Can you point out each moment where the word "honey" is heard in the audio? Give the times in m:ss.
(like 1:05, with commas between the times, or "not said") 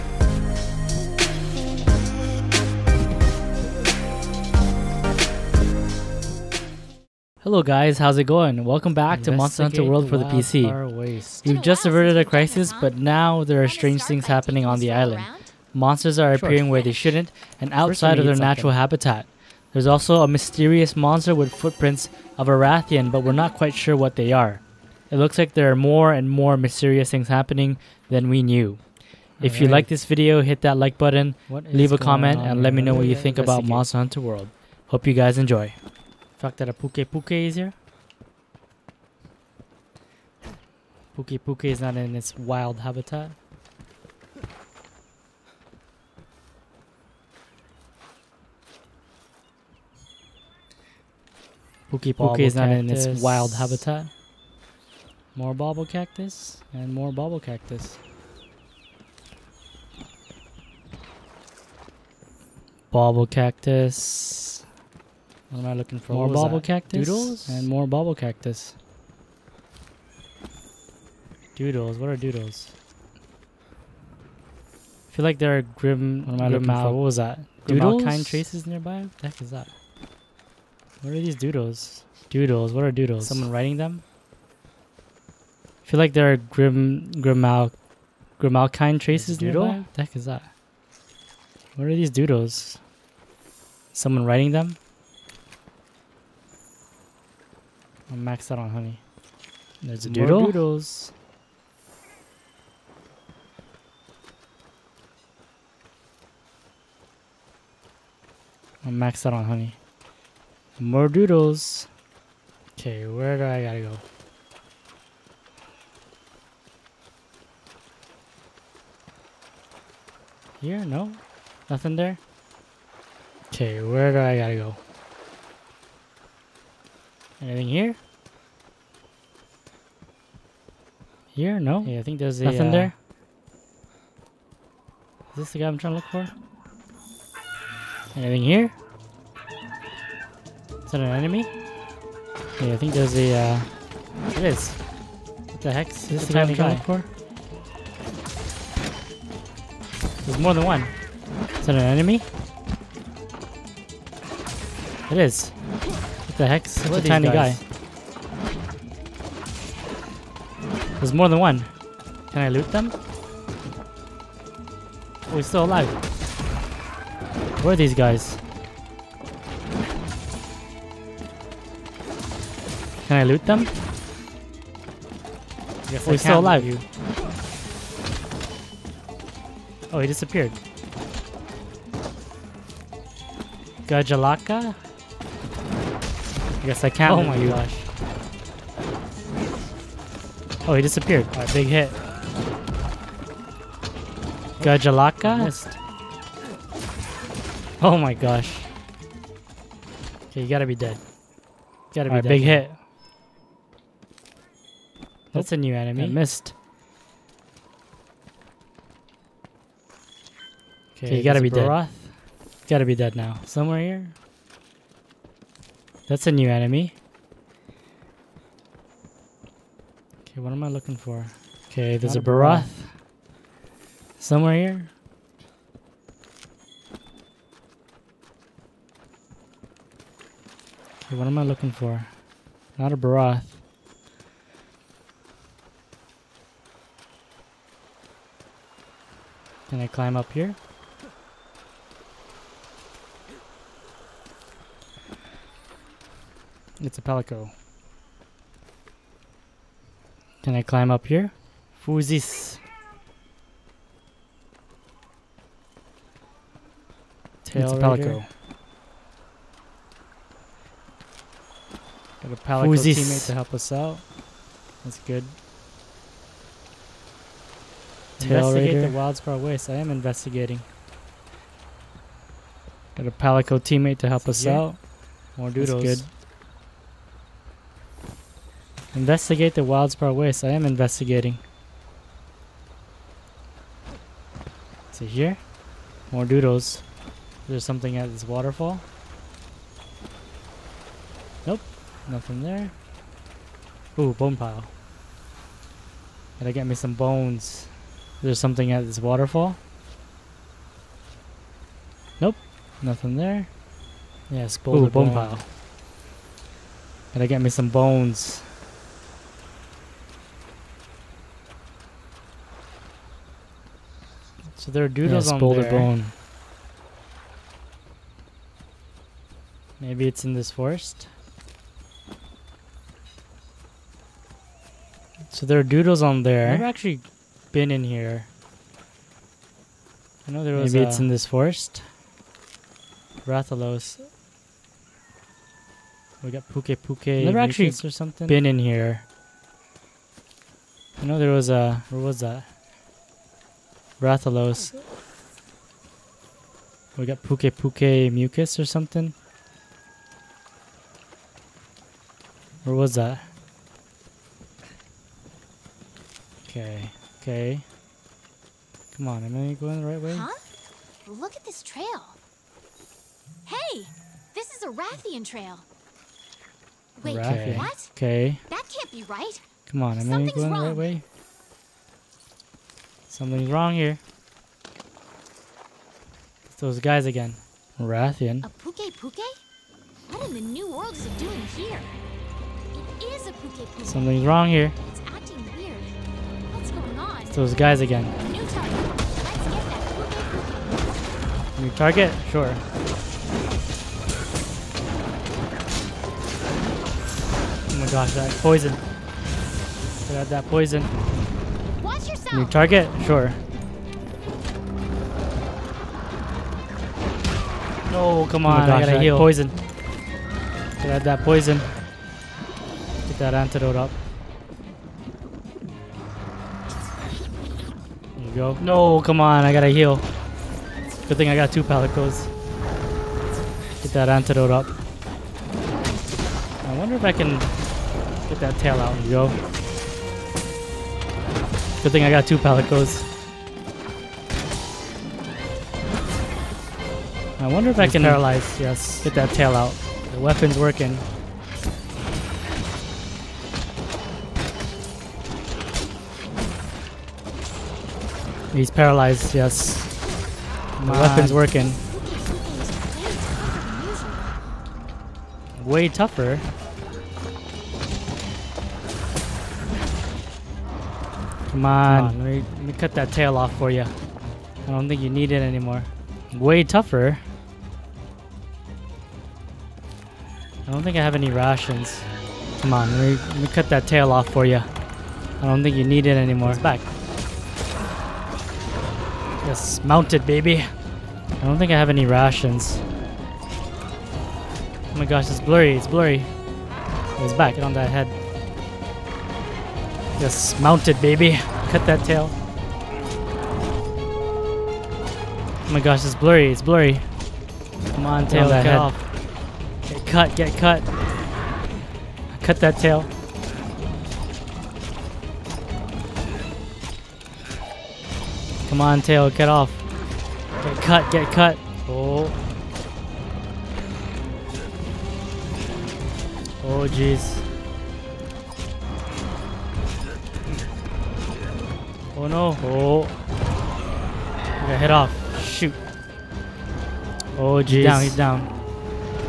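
1:38, 1:49.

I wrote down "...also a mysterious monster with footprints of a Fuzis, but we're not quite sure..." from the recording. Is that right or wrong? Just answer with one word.
wrong.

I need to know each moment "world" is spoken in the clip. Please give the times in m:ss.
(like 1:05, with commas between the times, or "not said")
0:09, 0:34, 6:20.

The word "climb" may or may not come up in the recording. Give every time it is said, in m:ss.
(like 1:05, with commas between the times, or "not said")
3:59, 4:10.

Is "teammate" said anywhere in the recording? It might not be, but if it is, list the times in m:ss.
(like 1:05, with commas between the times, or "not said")
4:22, 4:33.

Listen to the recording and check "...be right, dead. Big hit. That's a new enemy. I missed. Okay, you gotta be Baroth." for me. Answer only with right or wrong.
right.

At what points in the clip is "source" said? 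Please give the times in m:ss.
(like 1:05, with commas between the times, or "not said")
not said.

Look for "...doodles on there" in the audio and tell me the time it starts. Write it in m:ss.
5:25.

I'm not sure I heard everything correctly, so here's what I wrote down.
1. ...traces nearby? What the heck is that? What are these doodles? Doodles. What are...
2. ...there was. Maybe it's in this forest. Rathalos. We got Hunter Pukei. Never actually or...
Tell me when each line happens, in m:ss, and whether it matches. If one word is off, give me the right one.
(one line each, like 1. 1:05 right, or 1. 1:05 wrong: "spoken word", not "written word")
1. 1:17 right
2. 5:30 wrong: "Pukei", not "Hunter".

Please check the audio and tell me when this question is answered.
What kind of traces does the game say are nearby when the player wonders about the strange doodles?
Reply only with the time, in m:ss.
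1:28.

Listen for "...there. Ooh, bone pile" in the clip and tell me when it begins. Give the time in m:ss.
4:52.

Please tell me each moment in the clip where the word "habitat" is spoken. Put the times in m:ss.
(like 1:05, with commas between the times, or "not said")
0:18, 0:42, 0:53.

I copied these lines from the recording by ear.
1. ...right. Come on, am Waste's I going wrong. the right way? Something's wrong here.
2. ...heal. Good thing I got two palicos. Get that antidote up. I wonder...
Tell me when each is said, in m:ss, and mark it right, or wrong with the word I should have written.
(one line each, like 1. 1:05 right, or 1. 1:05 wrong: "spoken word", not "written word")
1. 6:09 wrong: "Something", not "Waste"
2. 6:59 right.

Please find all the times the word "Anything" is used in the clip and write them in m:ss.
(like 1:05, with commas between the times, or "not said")
2:07, 2:18.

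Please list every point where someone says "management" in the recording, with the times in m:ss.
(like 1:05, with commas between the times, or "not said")
not said.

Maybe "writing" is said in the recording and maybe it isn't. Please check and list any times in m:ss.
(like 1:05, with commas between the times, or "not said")
1:23, 1:34.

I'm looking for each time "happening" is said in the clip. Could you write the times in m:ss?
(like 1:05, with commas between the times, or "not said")
0:14, 0:27.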